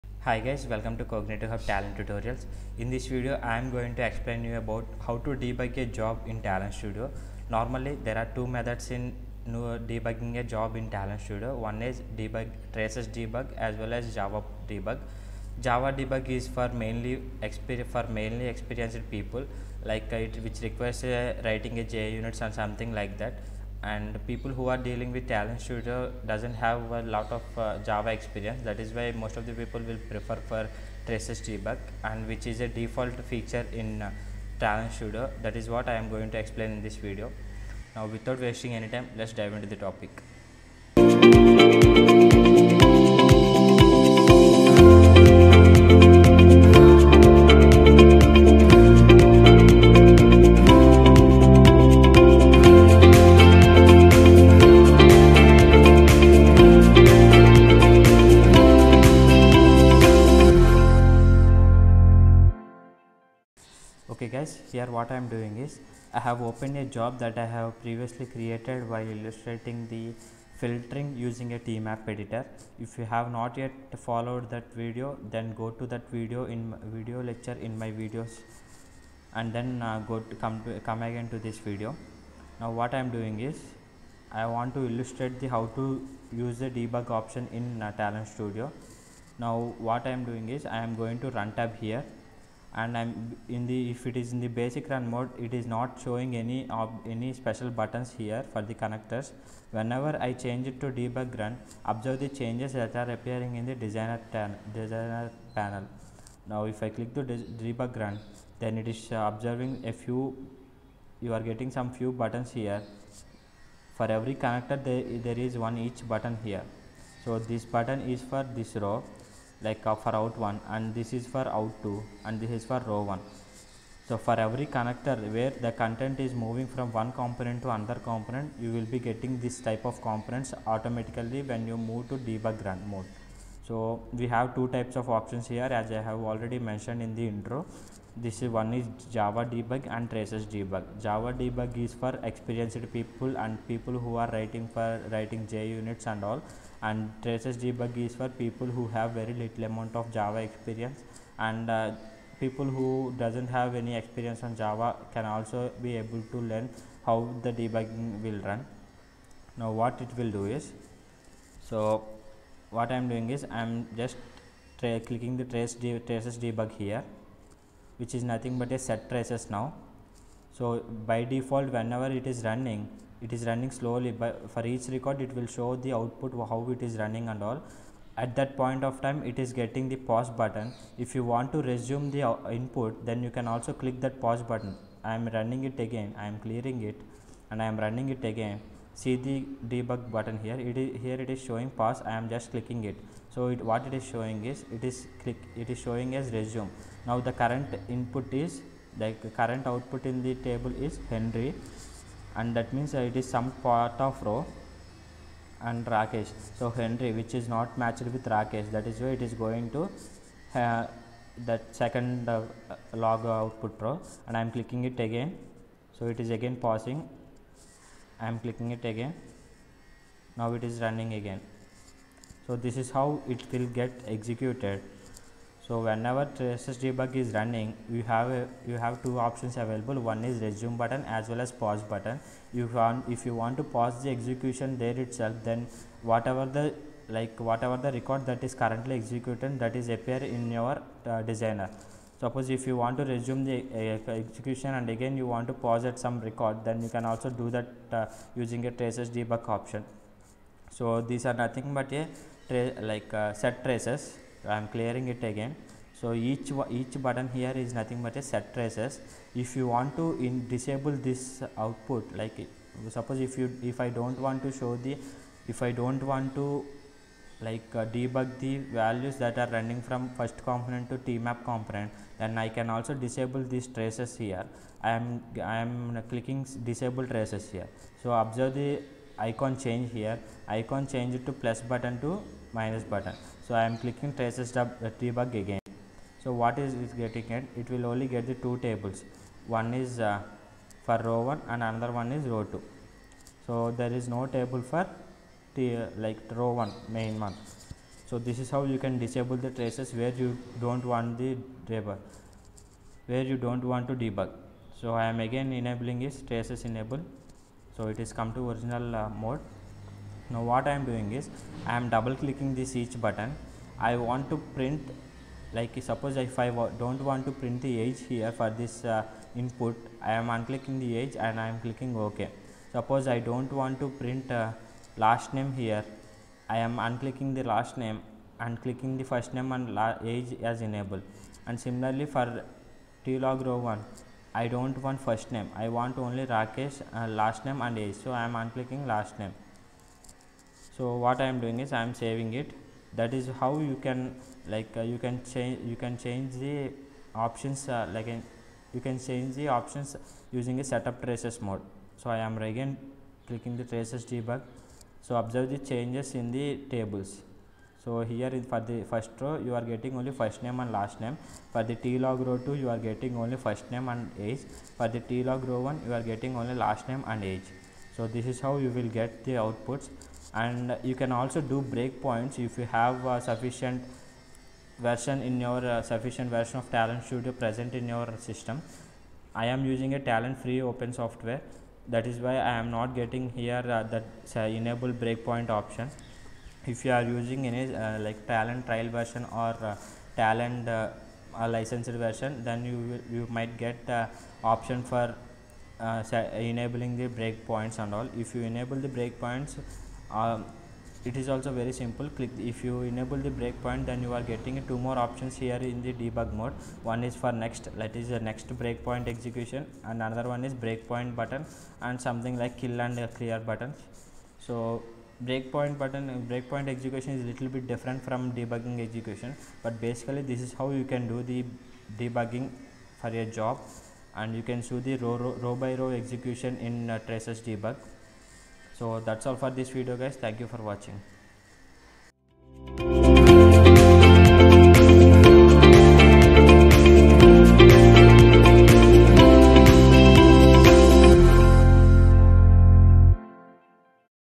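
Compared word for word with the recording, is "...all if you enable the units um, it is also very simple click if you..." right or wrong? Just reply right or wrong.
wrong.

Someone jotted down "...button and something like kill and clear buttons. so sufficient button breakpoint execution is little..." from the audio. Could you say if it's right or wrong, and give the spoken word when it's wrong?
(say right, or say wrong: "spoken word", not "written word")
wrong: "breakpoint", not "sufficient".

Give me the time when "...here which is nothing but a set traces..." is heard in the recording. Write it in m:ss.
2:46.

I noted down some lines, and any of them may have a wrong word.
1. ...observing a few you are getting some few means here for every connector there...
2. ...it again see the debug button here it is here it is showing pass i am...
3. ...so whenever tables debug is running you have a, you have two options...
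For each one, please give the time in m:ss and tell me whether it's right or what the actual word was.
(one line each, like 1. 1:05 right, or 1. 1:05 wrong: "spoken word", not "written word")
1. 1:49 wrong: "buttons", not "means"
2. 3:08 right
3. 3:45 wrong: "traces", not "tables".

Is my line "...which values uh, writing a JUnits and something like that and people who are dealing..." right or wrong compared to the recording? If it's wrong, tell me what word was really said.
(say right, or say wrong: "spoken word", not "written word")
wrong: "requires", not "values".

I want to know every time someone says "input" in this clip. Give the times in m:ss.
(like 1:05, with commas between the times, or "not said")
3:02, 3:17, 5:19.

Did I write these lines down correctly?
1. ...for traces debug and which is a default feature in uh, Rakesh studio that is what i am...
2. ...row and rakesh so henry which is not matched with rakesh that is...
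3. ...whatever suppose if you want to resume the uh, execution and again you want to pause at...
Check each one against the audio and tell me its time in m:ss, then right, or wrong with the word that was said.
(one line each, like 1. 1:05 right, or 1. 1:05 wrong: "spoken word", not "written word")
1. 0:30 wrong: "Talend", not "Rakesh"
2. 3:24 right
3. 4:01 wrong: "designer", not "whatever".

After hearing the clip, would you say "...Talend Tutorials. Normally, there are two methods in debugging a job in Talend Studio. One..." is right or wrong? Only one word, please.
wrong.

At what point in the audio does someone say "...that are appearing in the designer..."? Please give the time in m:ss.
1:42.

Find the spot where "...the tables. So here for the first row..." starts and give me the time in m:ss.
5:56.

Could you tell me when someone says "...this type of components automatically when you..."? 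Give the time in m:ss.
2:09.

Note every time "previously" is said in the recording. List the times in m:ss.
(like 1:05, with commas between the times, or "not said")
1:07.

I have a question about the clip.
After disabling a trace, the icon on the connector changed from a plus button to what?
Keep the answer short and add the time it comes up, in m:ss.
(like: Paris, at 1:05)
minus button, at 4:42.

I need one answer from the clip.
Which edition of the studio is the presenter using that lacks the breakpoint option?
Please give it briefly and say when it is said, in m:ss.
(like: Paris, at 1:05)
Talend free open software, at 6:19.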